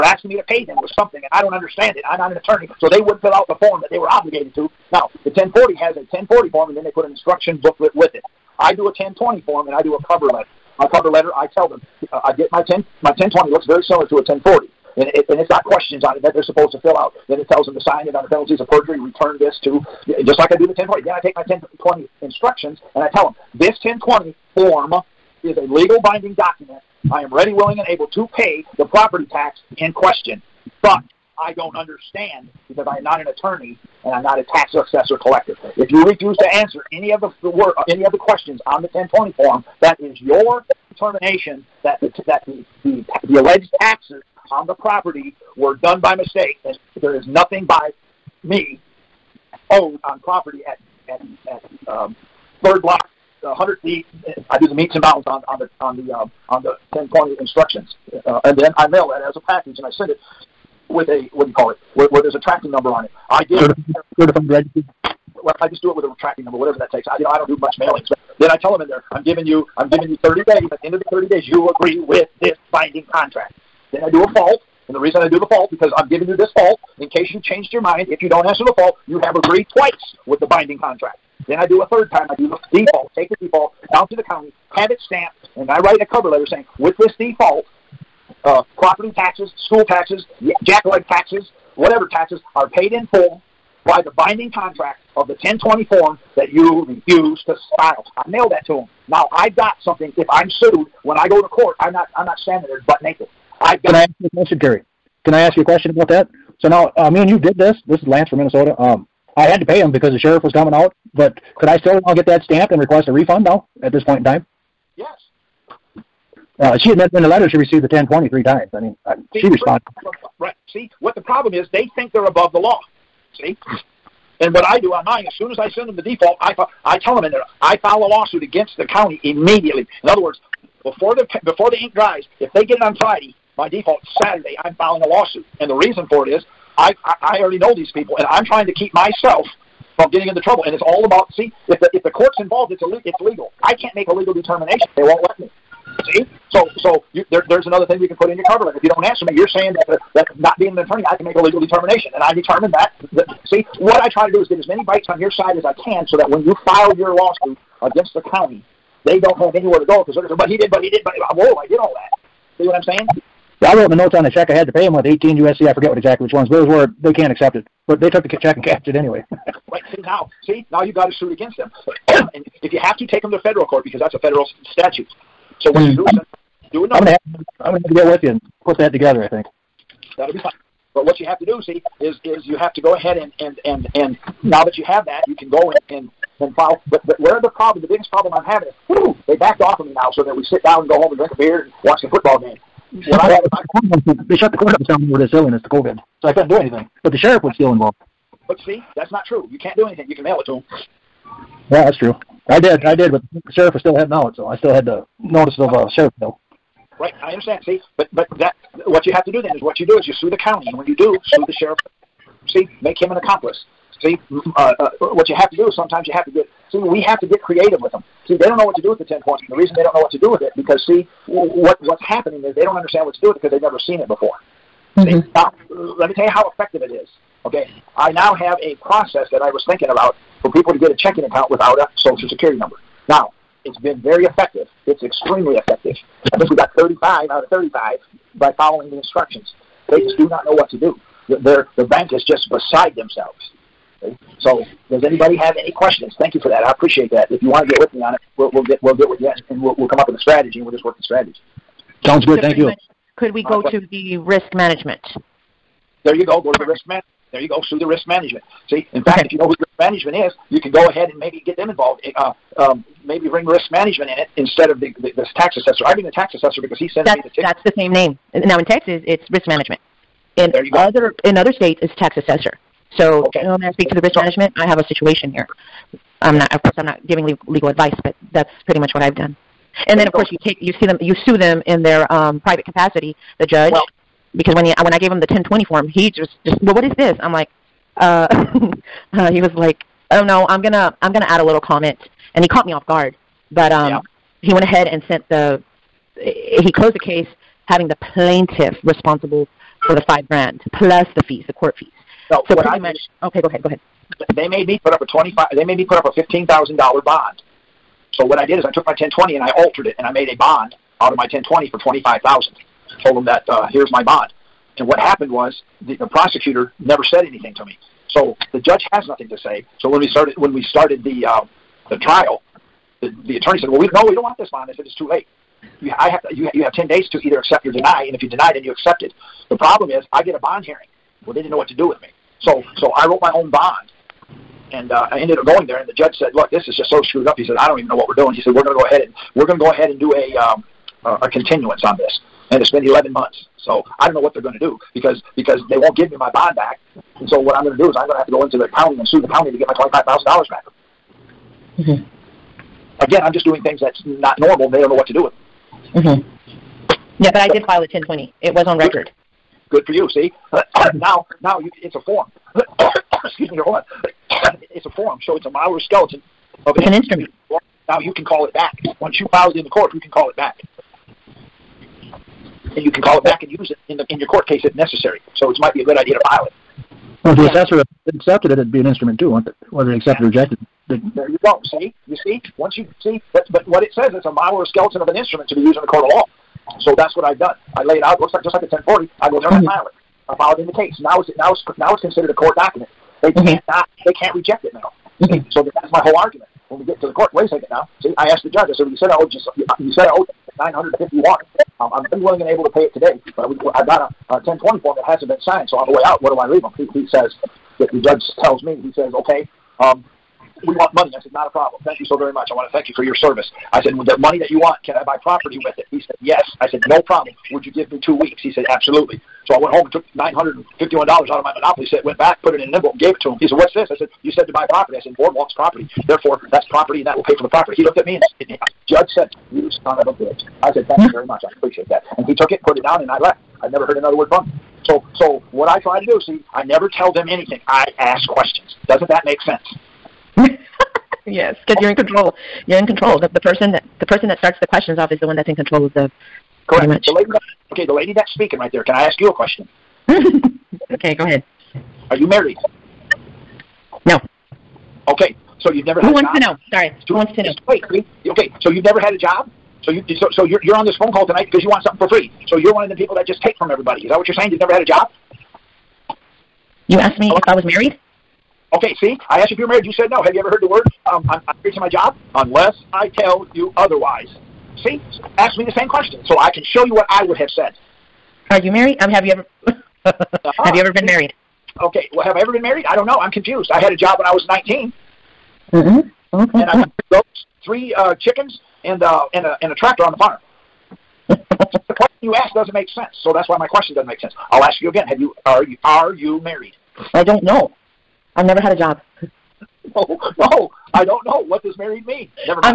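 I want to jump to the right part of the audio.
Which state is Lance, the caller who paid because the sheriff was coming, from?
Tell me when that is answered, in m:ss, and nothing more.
1:48.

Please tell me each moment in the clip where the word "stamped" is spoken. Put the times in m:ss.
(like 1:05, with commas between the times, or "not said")
1:25, 1:52.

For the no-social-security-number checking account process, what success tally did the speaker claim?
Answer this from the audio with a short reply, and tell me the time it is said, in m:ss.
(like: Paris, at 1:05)
35 out of 35, at 3:56.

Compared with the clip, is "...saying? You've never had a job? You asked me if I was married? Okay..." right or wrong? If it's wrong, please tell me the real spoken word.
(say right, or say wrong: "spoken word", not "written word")
right.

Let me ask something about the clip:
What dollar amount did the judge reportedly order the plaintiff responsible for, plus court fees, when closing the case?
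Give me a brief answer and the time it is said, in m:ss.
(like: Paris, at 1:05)
$5,000, at 5:00.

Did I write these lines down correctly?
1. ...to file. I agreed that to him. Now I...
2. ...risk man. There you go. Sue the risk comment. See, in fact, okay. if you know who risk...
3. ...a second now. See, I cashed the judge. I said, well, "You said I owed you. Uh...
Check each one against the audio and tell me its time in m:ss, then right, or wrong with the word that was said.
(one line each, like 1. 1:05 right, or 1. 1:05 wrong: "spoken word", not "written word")
1. 1:37 wrong: "mailed", not "agreed"
2. 4:16 wrong: "management", not "comment"
3. 6:37 wrong: "asked", not "cashed".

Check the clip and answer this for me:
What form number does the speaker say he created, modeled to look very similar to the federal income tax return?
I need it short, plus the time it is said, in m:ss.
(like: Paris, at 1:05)
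1020, at 0:08.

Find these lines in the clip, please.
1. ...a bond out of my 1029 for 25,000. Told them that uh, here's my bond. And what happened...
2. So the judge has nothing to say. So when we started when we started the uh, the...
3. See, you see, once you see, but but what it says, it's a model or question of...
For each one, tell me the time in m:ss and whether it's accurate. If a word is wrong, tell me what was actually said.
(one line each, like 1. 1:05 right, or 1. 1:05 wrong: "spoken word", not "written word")
1. 5:10 wrong: "1020", not "1029"
2. 5:18 right
3. 6:21 wrong: "skeleton", not "question".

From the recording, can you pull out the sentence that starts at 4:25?
I bring the tax assessor because he sends that's, me the ticket.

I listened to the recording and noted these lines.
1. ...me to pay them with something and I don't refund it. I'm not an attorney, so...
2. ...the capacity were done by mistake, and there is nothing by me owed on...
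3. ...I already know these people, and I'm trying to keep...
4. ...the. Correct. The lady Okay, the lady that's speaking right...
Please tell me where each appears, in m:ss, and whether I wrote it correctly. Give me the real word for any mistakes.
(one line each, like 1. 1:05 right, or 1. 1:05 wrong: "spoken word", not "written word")
1. 0:00 wrong: "understand", not "refund"
2. 0:44 wrong: "property", not "capacity"
3. 2:17 right
4. 7:25 right.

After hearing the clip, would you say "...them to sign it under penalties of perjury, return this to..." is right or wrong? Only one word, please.
right.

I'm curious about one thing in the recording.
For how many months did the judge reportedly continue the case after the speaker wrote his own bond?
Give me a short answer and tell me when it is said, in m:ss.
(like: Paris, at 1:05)
11, at 5:42.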